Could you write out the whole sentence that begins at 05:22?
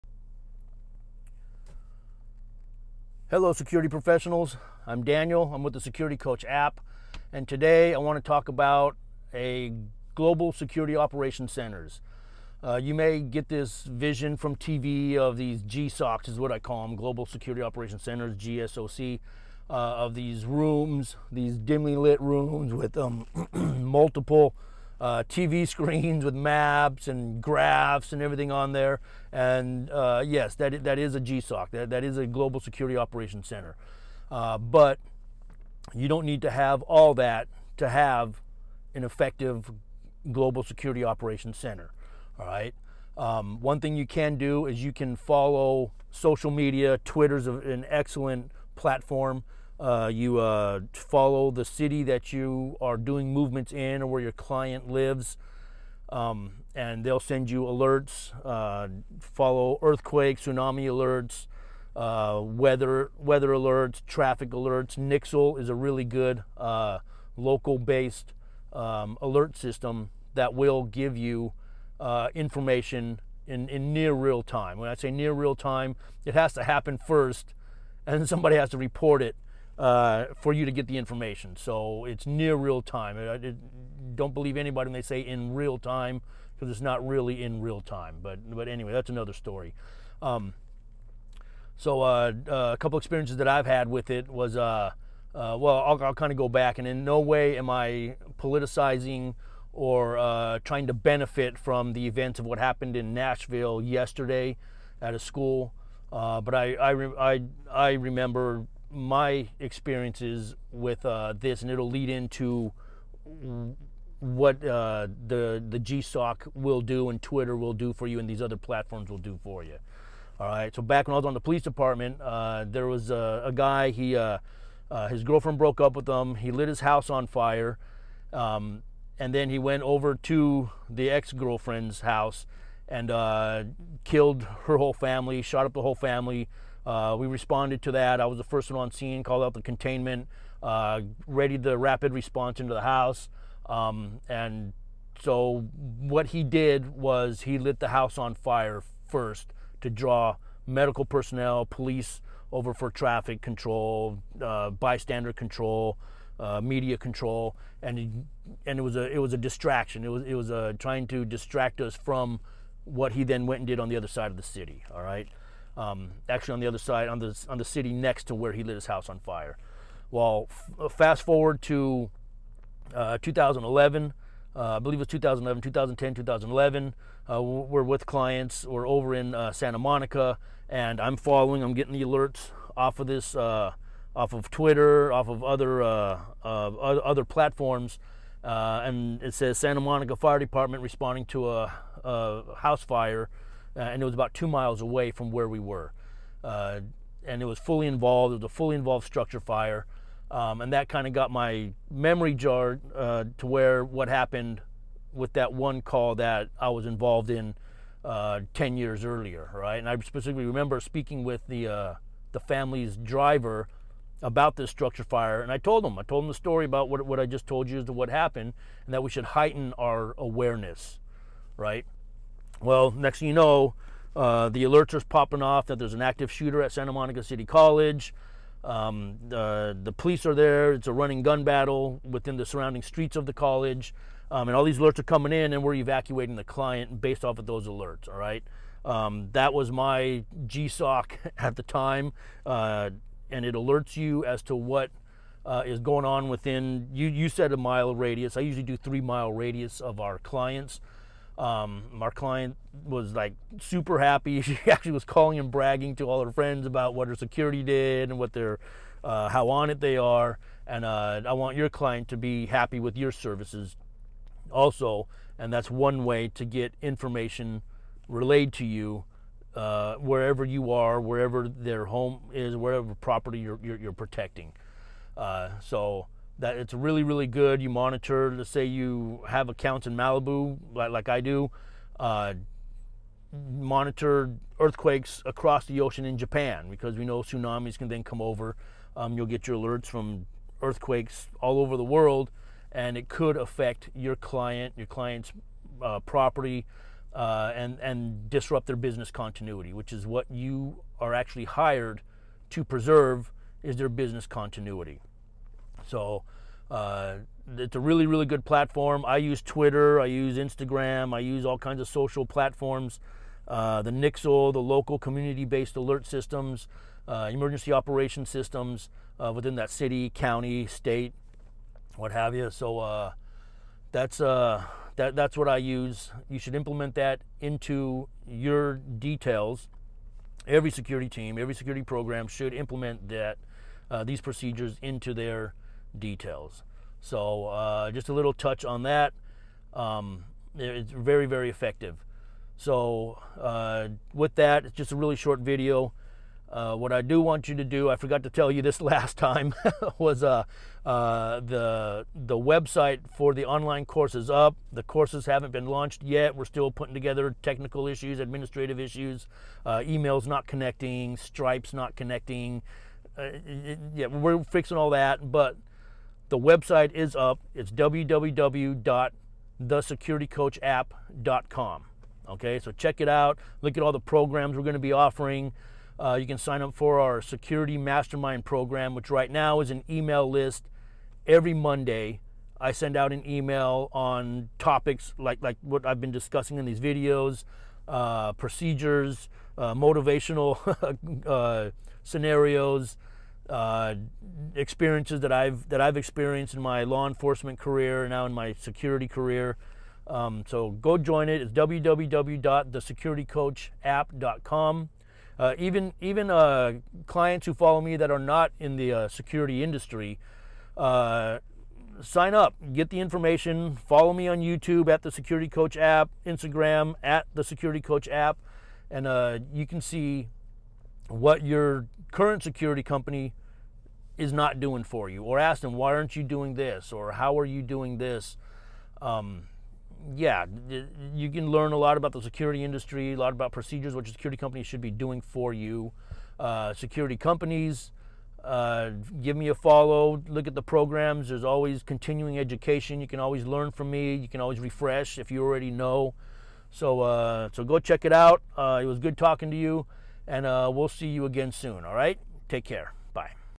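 So uh, that's uh, that, that's what I use.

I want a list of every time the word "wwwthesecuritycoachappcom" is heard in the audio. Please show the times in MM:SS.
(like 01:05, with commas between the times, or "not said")
06:07, 06:41.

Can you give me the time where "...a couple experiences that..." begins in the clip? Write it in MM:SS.
01:32.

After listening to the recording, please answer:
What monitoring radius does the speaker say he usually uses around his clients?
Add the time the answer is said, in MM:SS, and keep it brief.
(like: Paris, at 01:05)
3 miles, at 04:08.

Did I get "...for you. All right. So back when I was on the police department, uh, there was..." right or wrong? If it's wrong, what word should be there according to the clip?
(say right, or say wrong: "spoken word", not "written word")
right.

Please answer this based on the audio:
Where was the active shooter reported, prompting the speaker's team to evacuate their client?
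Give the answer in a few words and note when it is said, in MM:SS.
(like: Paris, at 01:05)
Santa Monica City College, at 03:46.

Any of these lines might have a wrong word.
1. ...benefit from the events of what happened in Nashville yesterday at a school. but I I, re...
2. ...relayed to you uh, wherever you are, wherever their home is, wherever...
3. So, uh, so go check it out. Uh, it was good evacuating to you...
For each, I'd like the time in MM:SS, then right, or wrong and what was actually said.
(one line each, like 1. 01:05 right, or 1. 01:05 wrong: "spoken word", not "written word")
1. 01:40 right
2. 04:28 right
3. 07:26 wrong: "talking", not "evacuating".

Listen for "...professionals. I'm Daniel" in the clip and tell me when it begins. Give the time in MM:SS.
00:03.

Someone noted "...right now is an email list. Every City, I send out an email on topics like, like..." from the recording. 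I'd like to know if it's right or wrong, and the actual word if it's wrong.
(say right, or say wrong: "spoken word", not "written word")
wrong: "Monday", not "City".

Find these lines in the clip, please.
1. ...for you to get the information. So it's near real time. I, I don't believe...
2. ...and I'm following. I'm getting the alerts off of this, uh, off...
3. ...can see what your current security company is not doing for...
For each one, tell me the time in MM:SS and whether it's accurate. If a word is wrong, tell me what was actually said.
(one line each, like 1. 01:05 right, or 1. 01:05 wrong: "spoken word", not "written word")
1. 01:20 right
2. 03:00 right
3. 06:59 right.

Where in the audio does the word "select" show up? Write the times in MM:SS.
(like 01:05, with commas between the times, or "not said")
not said.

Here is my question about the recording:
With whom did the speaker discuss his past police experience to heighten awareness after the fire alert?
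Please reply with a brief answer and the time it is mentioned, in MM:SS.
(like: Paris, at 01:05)
the family's driver, at 03:32.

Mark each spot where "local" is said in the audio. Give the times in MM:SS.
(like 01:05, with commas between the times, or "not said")
01:07, 05:14.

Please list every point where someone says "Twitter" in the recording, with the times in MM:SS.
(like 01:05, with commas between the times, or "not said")
00:47, 01:57, 03:04, 05:09.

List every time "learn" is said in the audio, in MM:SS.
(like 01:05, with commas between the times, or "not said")
07:11, 07:23.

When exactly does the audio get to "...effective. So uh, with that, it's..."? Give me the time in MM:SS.
05:41.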